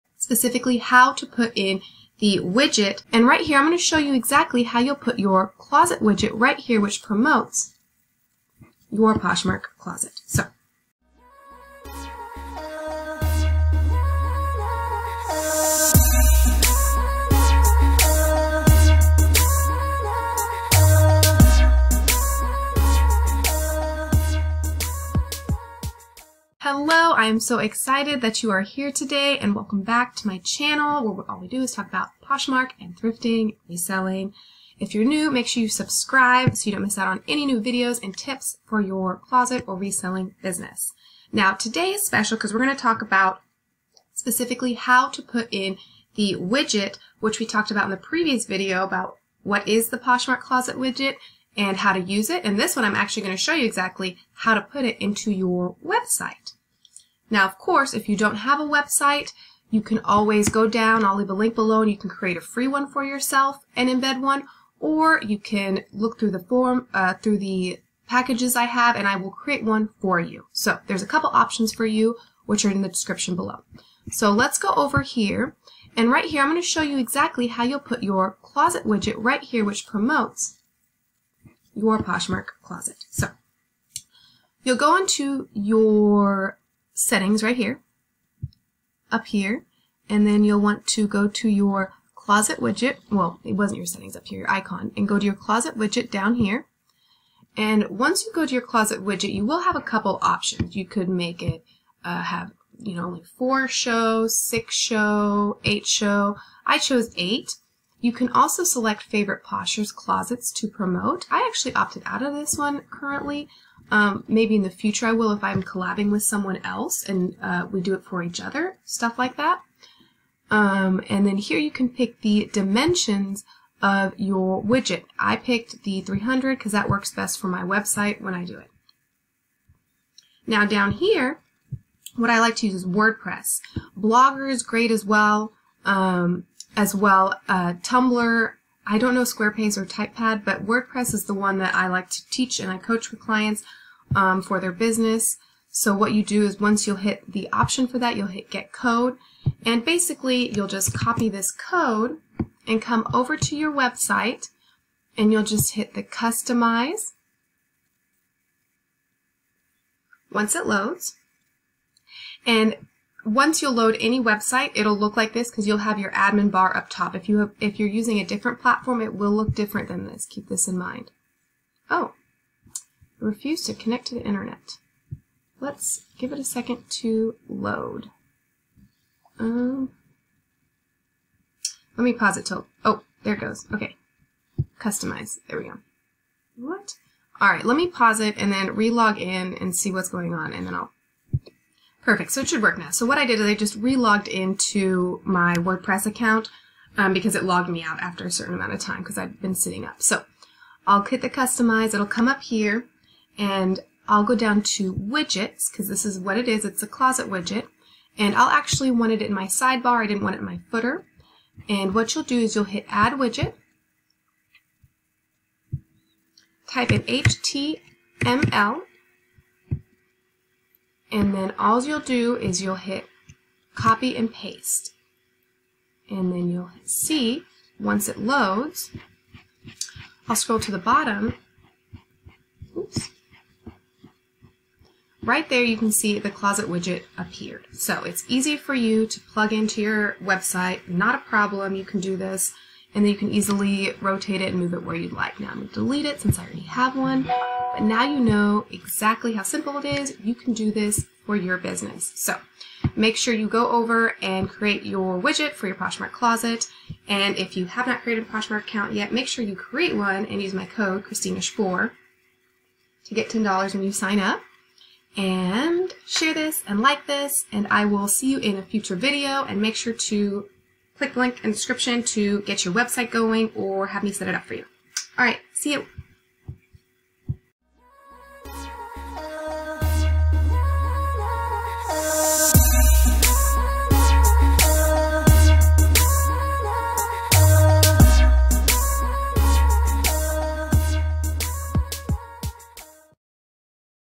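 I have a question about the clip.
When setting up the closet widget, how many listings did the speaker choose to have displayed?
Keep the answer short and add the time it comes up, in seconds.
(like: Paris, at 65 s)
8, at 106 s.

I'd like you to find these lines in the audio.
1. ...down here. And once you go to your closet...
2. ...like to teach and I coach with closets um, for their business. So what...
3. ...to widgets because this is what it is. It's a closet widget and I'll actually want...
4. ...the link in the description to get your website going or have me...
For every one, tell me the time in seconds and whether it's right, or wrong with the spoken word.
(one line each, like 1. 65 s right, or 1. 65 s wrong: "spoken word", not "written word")
1. 96 s right
2. 141 s wrong: "clients", not "closets"
3. 204 s right
4. 271 s right.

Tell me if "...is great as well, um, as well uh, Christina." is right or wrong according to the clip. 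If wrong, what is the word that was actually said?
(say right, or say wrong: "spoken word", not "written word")
wrong: "Tumblr", not "Christina".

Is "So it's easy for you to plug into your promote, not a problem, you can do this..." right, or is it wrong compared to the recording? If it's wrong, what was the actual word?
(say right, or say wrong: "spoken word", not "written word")
wrong: "website", not "promote".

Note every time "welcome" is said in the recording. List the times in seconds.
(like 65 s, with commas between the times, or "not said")
29 s.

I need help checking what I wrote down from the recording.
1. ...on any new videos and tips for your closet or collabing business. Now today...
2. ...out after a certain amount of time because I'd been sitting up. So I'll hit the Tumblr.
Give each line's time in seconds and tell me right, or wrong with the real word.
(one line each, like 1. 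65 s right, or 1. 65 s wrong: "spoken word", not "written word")
1. 37 s wrong: "reselling", not "collabing"
2. 197 s wrong: "Customize", not "Tumblr".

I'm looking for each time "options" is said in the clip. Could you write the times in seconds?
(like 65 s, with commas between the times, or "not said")
71 s, 100 s, 147 s.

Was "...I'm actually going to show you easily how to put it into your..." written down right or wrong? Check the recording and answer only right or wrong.
wrong.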